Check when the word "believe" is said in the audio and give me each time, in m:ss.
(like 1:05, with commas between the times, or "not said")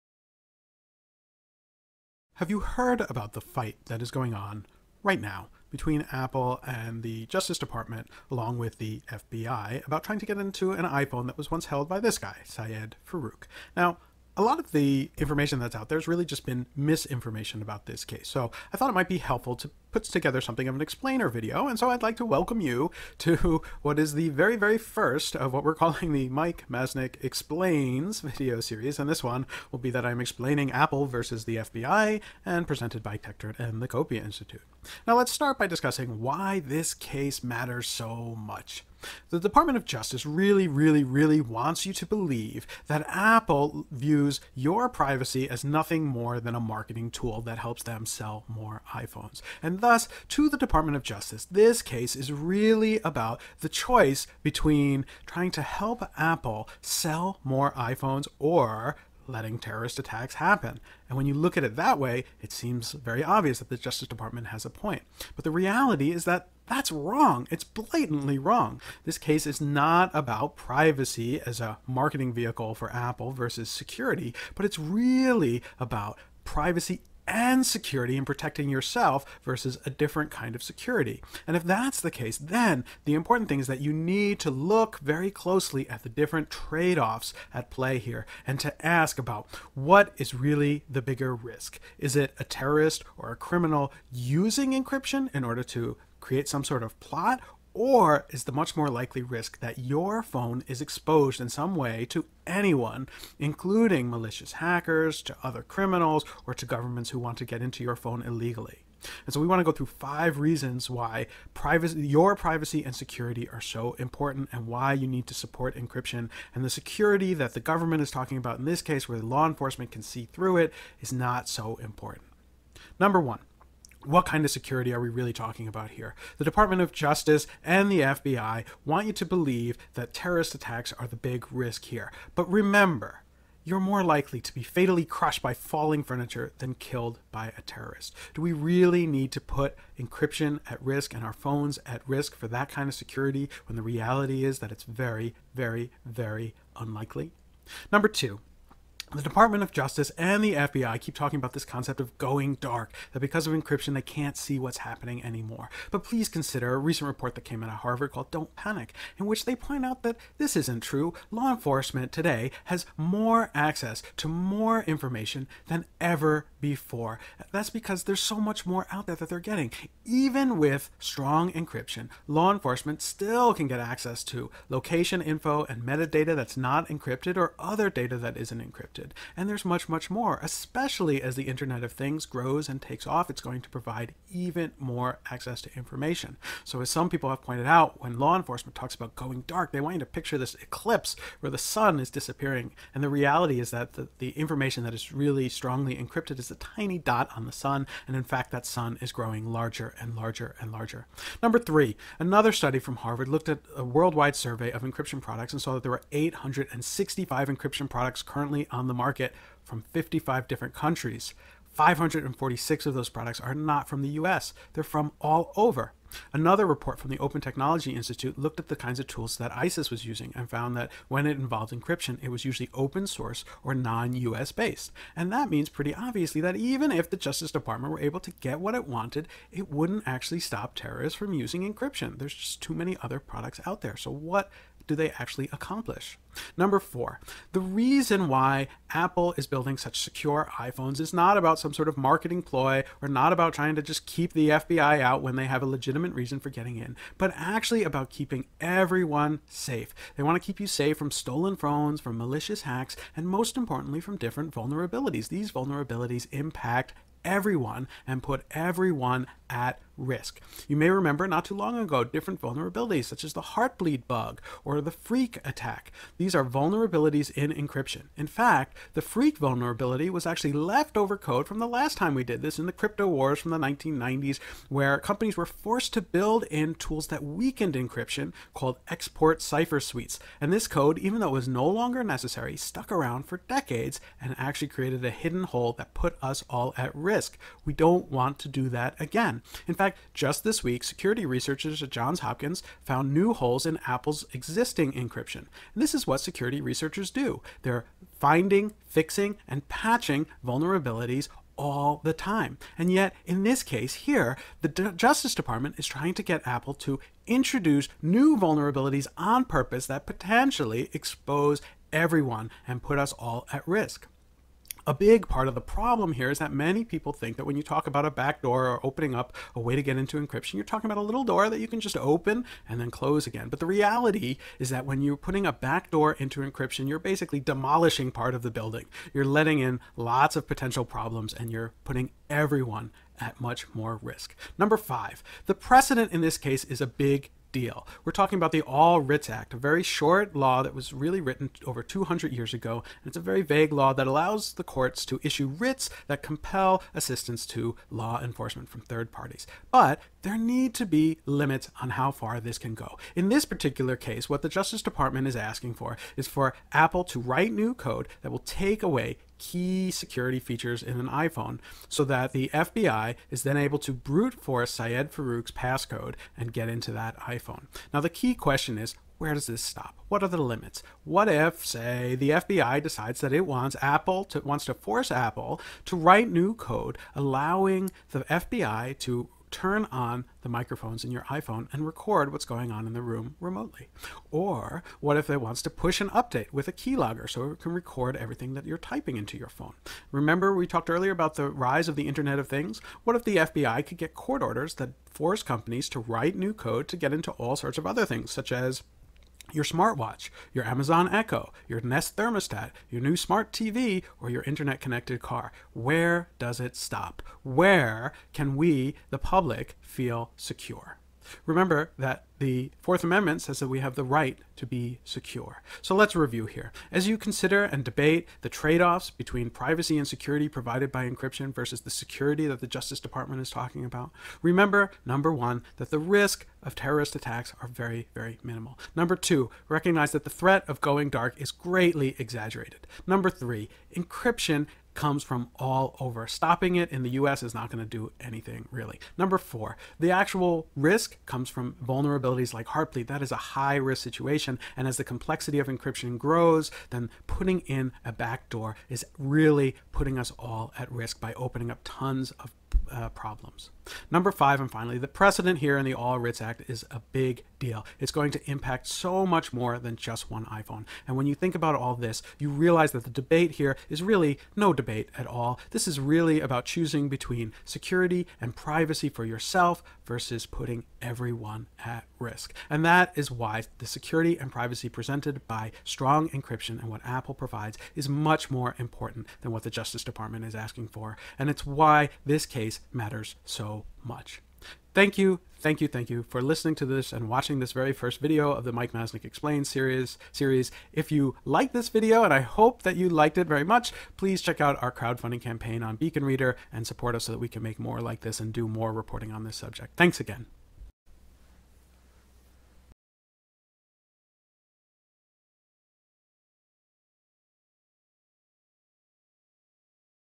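0:42, 2:09.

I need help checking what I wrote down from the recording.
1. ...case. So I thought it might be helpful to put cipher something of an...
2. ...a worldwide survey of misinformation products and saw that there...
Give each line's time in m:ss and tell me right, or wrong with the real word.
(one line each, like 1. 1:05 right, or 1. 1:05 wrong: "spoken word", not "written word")
1. 0:18 wrong: "together", not "cipher"
2. 3:23 wrong: "encryption", not "misinformation".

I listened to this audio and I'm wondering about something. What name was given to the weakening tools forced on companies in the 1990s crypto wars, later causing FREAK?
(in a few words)
export cipher suites.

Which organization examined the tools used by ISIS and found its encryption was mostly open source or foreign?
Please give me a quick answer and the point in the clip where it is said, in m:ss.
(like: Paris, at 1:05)
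Open Technology Institute, at 3:37.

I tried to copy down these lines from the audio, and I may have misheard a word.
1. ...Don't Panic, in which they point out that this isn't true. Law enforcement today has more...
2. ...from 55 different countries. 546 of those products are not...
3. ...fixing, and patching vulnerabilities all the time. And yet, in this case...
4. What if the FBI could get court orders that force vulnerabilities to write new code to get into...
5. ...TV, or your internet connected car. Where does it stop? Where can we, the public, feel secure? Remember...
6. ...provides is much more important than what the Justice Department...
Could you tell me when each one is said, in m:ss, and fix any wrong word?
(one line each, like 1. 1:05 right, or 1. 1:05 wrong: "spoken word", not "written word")
1. 2:38 right
2. 3:29 right
3. 4:58 right
4. 6:33 wrong: "companies", not "vulnerabilities"
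5. 6:43 right
6. 7:57 right.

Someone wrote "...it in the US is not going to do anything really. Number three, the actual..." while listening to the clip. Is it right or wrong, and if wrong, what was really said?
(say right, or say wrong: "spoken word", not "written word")
wrong: "four", not "three".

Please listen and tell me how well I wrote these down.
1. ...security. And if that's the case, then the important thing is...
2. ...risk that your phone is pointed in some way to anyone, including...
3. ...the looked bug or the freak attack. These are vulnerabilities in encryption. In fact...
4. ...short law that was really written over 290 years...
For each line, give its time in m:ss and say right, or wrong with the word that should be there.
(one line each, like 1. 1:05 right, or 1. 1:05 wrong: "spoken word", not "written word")
1. 1:20 right
2. 1:39 wrong: "exposed", not "pointed"
3. 4:23 wrong: "heartbleed", not "looked"
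4. 5:39 wrong: "200", not "290".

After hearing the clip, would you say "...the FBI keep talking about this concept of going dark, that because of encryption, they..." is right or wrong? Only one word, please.
right.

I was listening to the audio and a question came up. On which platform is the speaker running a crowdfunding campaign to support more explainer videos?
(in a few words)
Beacon Reader.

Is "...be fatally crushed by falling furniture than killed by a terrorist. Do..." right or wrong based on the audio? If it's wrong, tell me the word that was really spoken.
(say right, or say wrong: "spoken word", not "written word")
right.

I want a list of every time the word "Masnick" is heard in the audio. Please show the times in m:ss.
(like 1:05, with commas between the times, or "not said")
0:26, 8:08.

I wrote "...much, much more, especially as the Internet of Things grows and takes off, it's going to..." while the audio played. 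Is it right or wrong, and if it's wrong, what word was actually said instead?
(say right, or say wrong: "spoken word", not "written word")
right.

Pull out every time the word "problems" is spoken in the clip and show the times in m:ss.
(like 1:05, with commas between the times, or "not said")
5:15, 5:30, 7:33.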